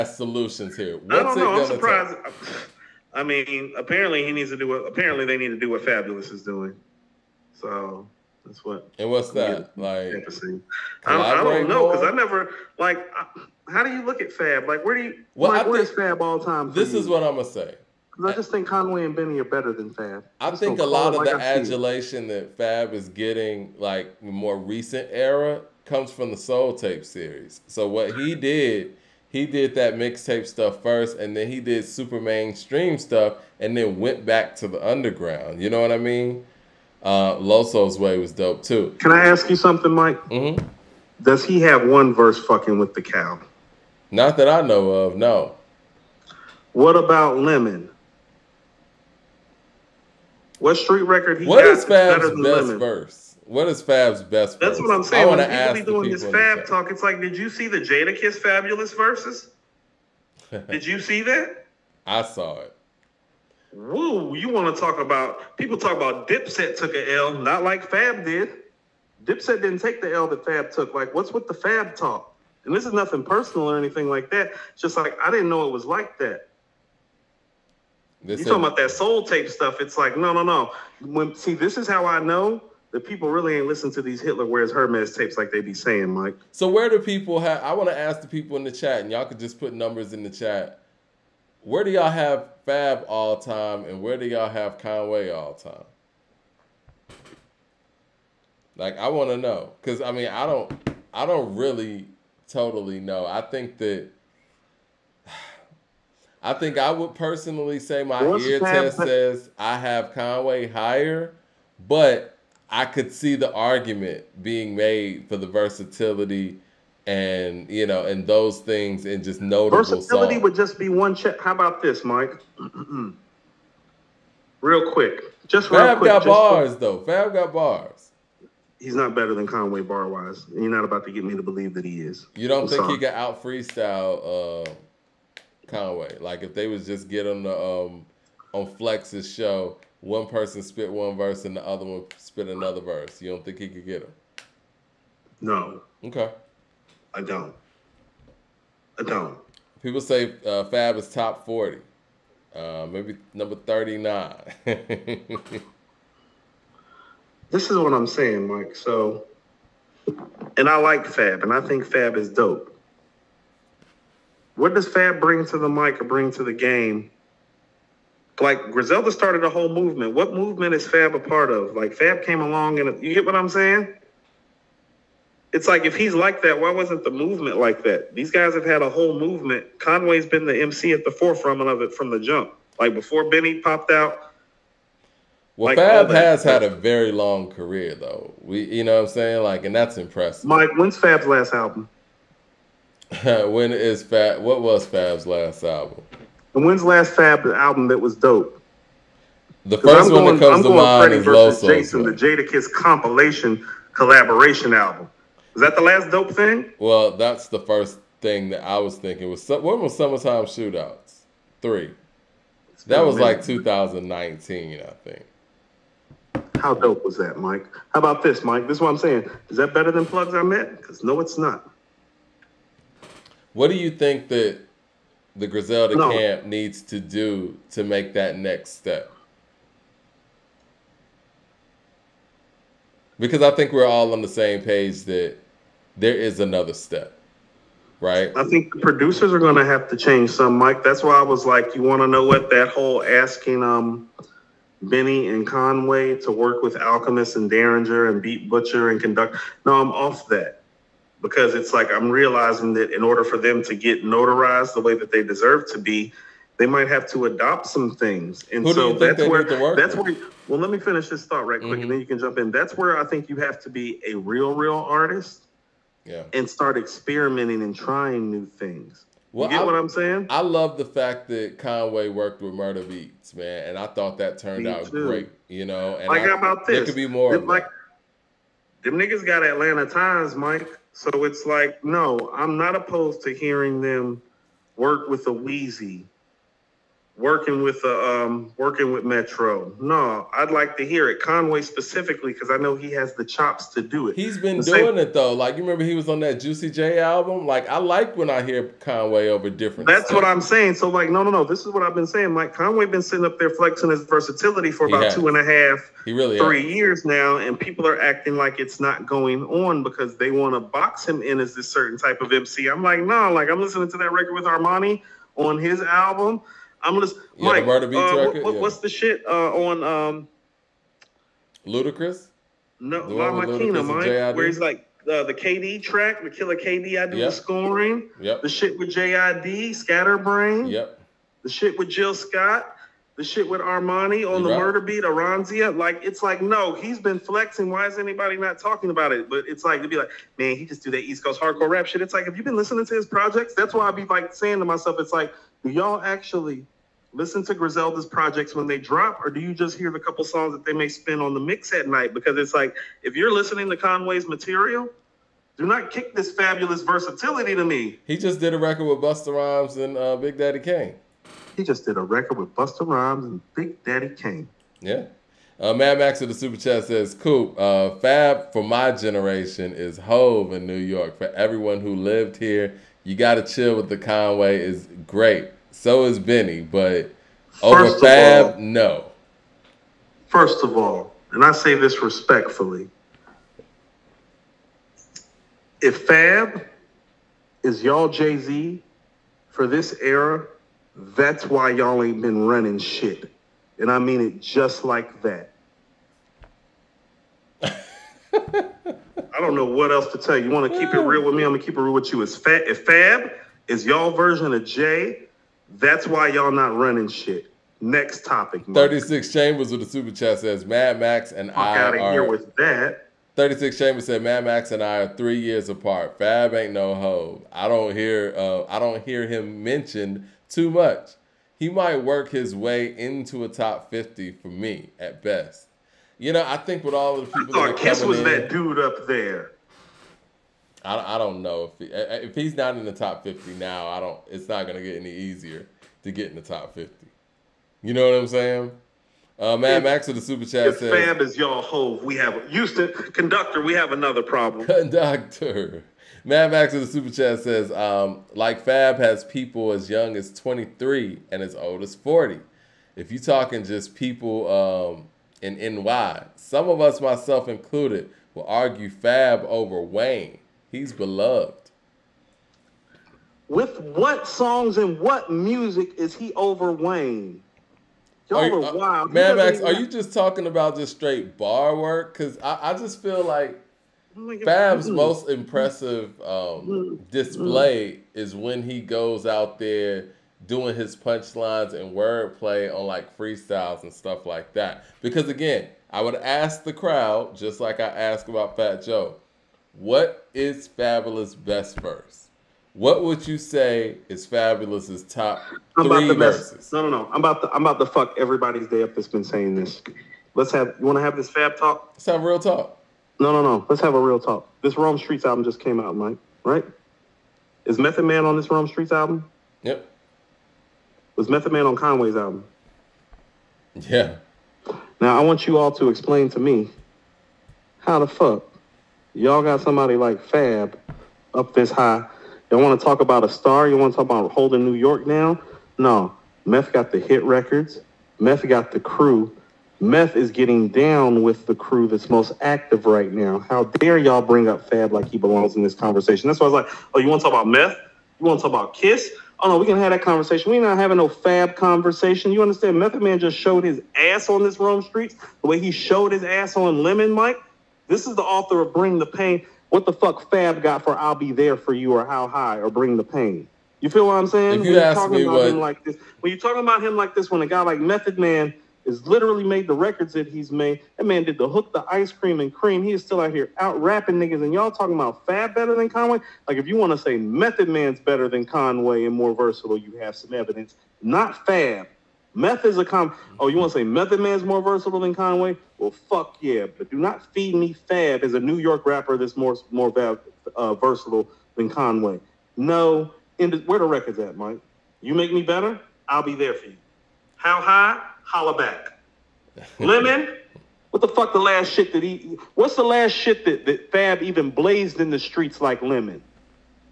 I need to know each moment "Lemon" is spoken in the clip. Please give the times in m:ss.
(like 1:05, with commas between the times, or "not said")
0:47, 0:52, 9:06, 9:49, 9:55.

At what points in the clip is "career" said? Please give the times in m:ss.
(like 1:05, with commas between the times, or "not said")
3:07.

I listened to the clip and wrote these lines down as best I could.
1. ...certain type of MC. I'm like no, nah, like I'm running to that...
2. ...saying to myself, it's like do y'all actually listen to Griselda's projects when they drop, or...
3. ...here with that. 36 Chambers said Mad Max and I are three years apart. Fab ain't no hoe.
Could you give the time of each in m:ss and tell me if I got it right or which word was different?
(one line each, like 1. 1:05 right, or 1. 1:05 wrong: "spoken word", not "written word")
1. 5:11 wrong: "listening", not "running"
2. 5:44 right
3. 6:52 right.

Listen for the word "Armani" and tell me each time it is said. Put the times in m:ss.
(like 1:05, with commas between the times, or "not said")
5:14, 5:33.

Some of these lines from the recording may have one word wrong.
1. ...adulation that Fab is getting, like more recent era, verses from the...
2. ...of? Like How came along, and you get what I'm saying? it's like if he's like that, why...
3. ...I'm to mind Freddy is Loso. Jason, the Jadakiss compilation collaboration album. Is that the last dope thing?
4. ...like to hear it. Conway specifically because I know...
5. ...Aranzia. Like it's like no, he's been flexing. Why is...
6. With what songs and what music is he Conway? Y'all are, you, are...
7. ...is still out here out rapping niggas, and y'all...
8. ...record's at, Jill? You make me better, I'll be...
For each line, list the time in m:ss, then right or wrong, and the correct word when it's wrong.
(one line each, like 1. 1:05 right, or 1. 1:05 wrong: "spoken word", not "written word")
1. 0:21 wrong: "comes", not "verses"
2. 2:51 wrong: "Fab", not "How"
3. 3:20 right
4. 4:50 right
5. 5:35 right
6. 7:43 wrong: "Wayne", not "Conway"
7. 9:22 right
8. 9:43 wrong: "Mike", not "Jill".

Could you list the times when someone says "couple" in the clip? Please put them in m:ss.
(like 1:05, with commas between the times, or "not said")
5:49.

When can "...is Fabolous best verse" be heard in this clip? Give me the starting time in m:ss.
8:10.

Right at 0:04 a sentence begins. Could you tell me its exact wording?
What, apparently they need to do what Fabolous is doing.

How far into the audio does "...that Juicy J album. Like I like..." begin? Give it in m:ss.
4:56.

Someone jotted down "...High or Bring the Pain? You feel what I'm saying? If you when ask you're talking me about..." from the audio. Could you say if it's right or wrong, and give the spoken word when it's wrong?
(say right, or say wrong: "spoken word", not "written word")
right.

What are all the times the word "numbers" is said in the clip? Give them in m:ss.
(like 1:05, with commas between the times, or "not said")
1:29, 2:33.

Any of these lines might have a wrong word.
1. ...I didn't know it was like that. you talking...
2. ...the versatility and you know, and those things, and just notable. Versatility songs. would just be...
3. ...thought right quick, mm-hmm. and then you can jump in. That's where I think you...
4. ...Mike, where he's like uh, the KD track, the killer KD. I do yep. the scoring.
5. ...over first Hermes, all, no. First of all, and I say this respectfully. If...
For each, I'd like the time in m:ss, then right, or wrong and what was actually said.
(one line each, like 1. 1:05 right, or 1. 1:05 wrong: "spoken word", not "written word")
1. 1:15 right
2. 1:55 right
3. 4:21 right
4. 5:23 right
5. 6:17 wrong: "Fab", not "Hermes".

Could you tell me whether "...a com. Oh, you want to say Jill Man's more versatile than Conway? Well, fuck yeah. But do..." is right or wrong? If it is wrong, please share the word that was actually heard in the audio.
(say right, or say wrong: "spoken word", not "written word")
wrong: "Method", not "Jill".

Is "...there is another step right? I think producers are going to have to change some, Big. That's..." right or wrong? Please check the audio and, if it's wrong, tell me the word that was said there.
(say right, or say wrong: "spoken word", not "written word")
wrong: "Mike", not "Big".